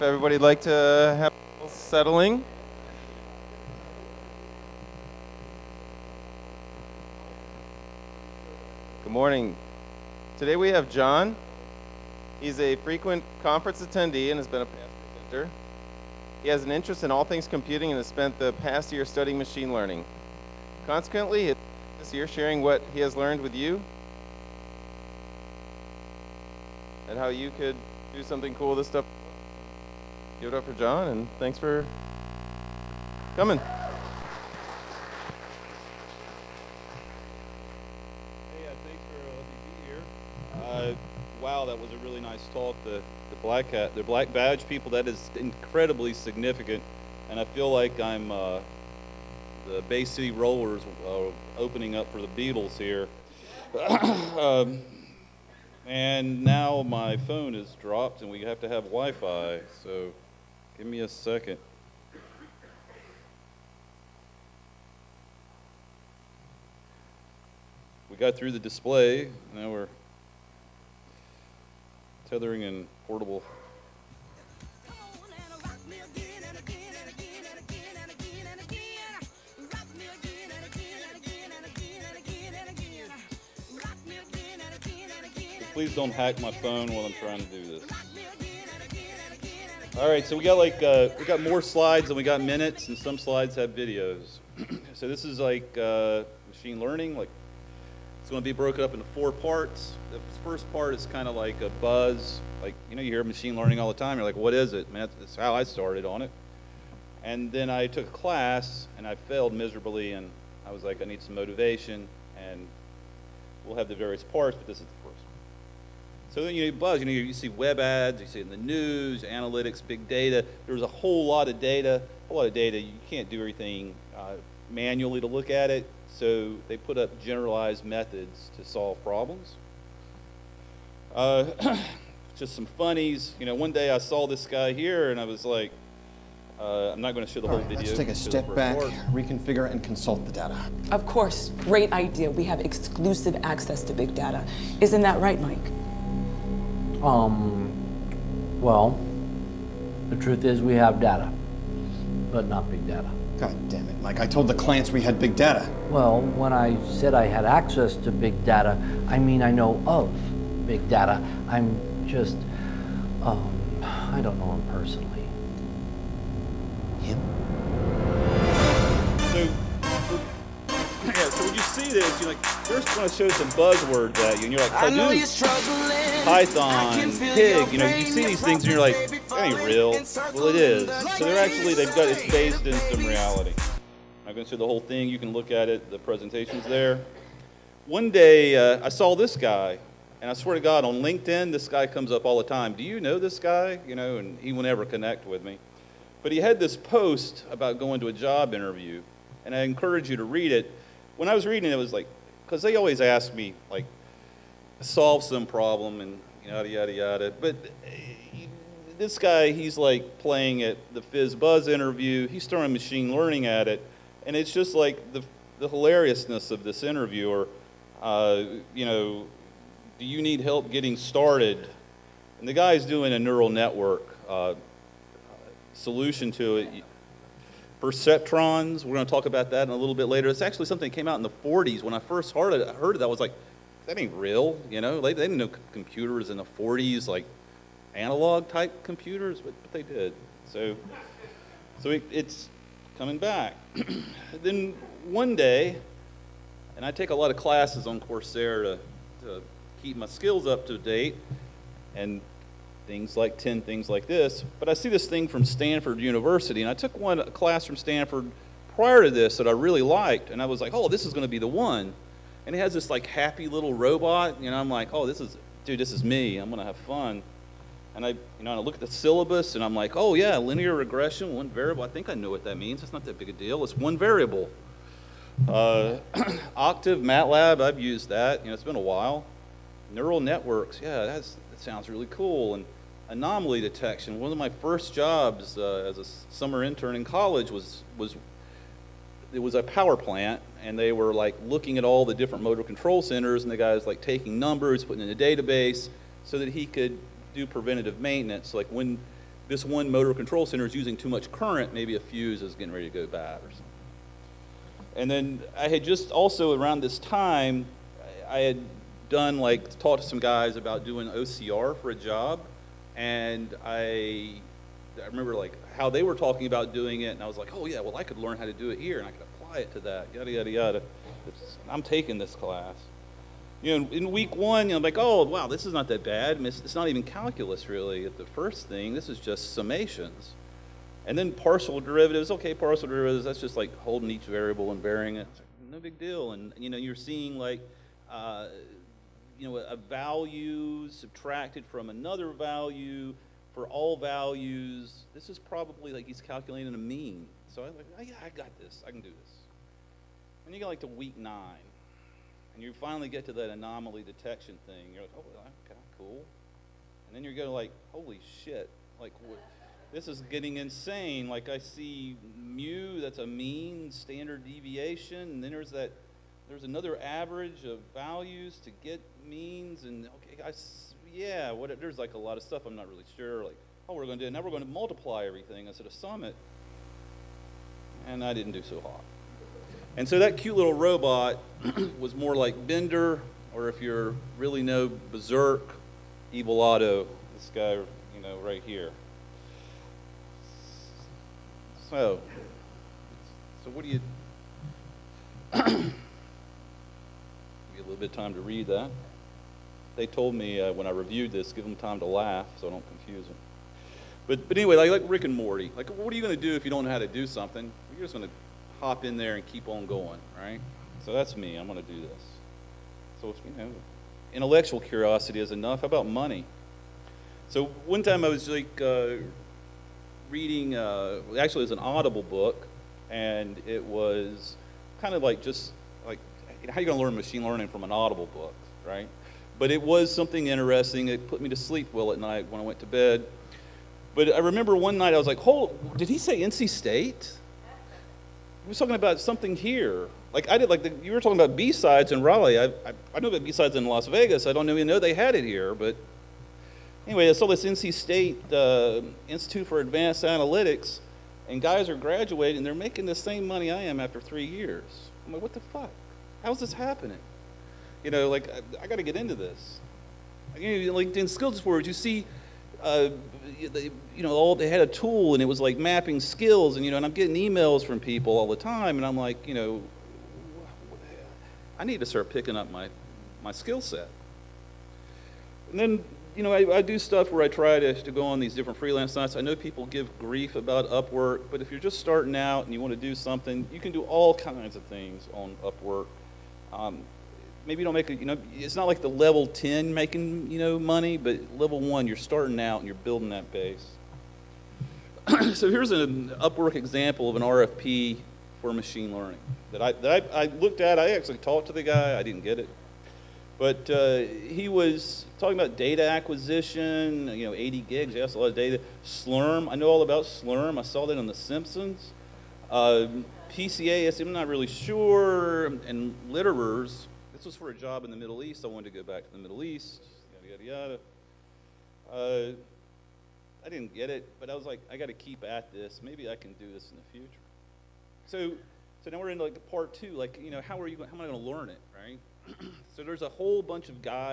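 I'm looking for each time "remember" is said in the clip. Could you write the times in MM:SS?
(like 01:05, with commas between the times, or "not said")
05:15, 07:14.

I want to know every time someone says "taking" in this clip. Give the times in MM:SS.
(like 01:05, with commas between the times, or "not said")
04:53, 05:21.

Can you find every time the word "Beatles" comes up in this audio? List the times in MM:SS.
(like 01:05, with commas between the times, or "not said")
00:52.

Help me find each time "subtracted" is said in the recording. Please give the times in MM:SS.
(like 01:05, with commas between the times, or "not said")
05:40.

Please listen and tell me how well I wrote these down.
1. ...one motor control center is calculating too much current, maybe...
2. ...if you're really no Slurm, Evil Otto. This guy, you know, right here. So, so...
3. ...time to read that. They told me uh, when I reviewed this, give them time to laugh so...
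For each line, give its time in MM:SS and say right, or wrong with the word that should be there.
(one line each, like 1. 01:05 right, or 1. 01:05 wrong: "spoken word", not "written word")
1. 04:59 wrong: "using", not "calculating"
2. 06:23 wrong: "Berserk", not "Slurm"
3. 06:38 right.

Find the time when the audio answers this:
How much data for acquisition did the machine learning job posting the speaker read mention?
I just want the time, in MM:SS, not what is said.
08:27.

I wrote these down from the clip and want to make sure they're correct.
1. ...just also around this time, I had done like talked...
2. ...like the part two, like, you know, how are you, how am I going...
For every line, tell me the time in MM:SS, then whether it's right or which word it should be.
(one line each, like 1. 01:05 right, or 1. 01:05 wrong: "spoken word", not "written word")
1. 05:05 right
2. 08:49 right.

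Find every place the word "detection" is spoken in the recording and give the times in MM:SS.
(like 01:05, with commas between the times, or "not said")
04:43, 05:54.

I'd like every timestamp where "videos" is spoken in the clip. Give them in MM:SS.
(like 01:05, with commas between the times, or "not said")
01:33, 02:17.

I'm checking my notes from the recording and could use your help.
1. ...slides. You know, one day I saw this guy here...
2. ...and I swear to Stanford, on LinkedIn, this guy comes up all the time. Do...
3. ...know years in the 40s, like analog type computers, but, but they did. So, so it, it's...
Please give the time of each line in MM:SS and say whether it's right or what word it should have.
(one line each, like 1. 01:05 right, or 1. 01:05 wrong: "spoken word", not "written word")
1. 02:12 wrong: "funnies", not "slides"
2. 03:10 wrong: "God", not "Stanford"
3. 03:55 wrong: "computers", not "years".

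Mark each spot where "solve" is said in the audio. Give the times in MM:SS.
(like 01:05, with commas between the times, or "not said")
02:08, 03:24.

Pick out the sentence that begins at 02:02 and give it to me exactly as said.
You can't do everything uh, manually to look at it.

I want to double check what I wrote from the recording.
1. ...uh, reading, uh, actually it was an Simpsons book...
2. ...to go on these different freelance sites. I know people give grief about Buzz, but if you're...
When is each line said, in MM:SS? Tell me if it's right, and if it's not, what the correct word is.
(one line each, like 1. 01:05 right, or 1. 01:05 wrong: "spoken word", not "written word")
1. 06:58 wrong: "Audible", not "Simpsons"
2. 07:58 wrong: "Upwork", not "Buzz".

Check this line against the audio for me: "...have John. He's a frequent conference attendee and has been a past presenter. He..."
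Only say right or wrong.
right.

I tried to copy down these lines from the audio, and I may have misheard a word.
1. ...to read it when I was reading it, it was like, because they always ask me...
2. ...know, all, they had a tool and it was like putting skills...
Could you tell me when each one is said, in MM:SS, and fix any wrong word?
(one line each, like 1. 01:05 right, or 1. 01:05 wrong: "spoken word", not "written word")
1. 03:20 right
2. 07:44 wrong: "mapping", not "putting".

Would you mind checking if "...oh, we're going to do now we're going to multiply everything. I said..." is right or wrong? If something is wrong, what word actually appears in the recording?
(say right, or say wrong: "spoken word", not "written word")
right.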